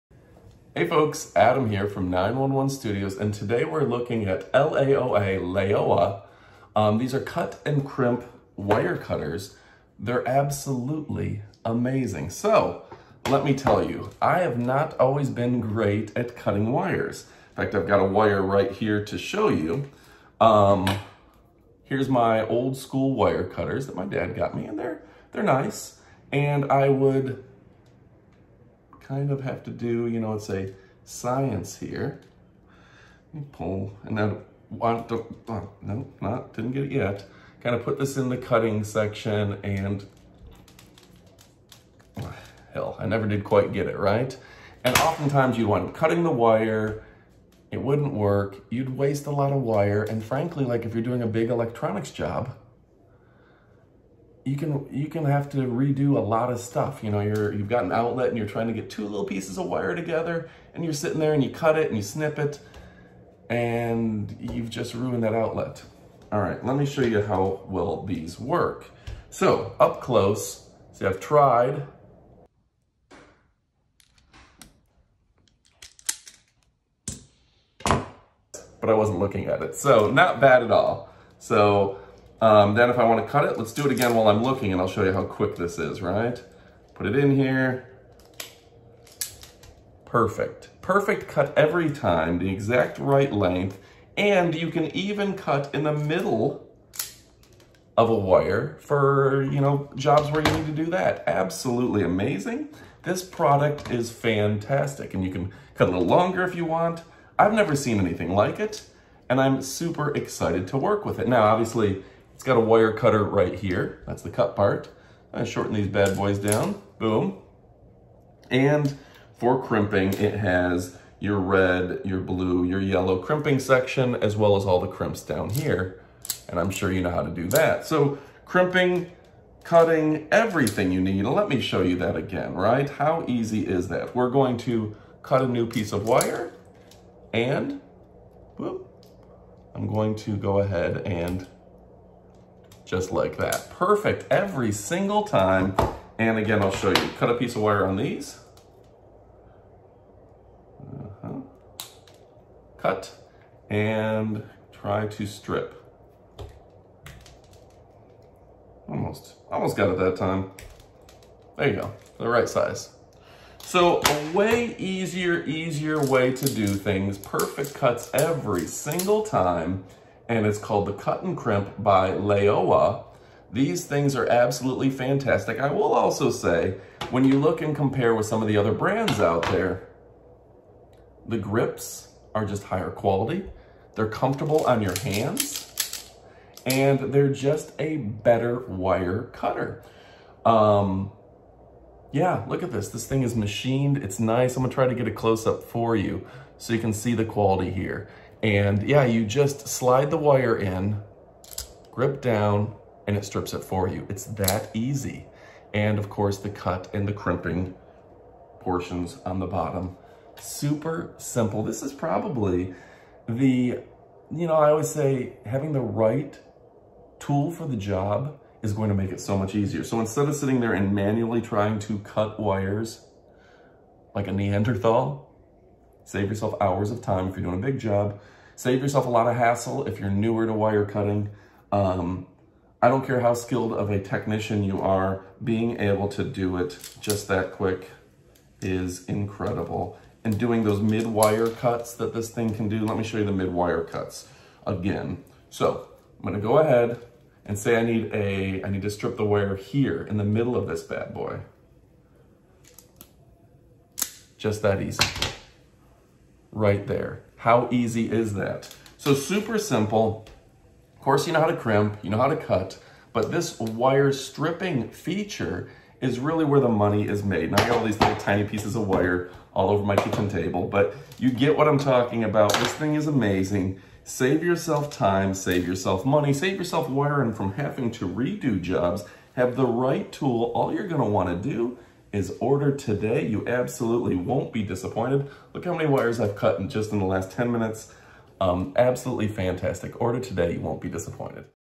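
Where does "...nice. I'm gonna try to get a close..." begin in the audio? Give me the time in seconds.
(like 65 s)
194 s.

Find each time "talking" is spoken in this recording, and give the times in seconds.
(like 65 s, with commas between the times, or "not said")
271 s.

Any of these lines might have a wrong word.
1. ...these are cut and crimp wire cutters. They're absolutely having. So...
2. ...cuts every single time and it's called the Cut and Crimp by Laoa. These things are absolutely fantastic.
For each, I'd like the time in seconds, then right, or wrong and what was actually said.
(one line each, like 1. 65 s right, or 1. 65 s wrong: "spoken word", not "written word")
1. 6 s wrong: "amazing", not "having"
2. 167 s right.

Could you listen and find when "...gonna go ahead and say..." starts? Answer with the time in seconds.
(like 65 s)
246 s.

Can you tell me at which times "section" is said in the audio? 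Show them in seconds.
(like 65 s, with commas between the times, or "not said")
38 s, 123 s.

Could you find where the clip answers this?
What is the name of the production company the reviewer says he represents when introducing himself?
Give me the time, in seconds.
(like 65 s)
2 s.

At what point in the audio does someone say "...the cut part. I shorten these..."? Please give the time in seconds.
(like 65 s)
114 s.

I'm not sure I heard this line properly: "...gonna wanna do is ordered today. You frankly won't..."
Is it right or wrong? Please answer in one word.
wrong.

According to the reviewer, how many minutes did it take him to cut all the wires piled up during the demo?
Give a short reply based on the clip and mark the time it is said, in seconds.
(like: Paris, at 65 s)
10 minutes, at 287 s.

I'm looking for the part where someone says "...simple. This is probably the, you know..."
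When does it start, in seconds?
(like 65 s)
211 s.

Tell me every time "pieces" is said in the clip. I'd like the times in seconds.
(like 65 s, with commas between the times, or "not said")
59 s, 135 s, 147 s, 268 s.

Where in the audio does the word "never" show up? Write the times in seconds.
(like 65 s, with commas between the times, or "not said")
43 s, 107 s.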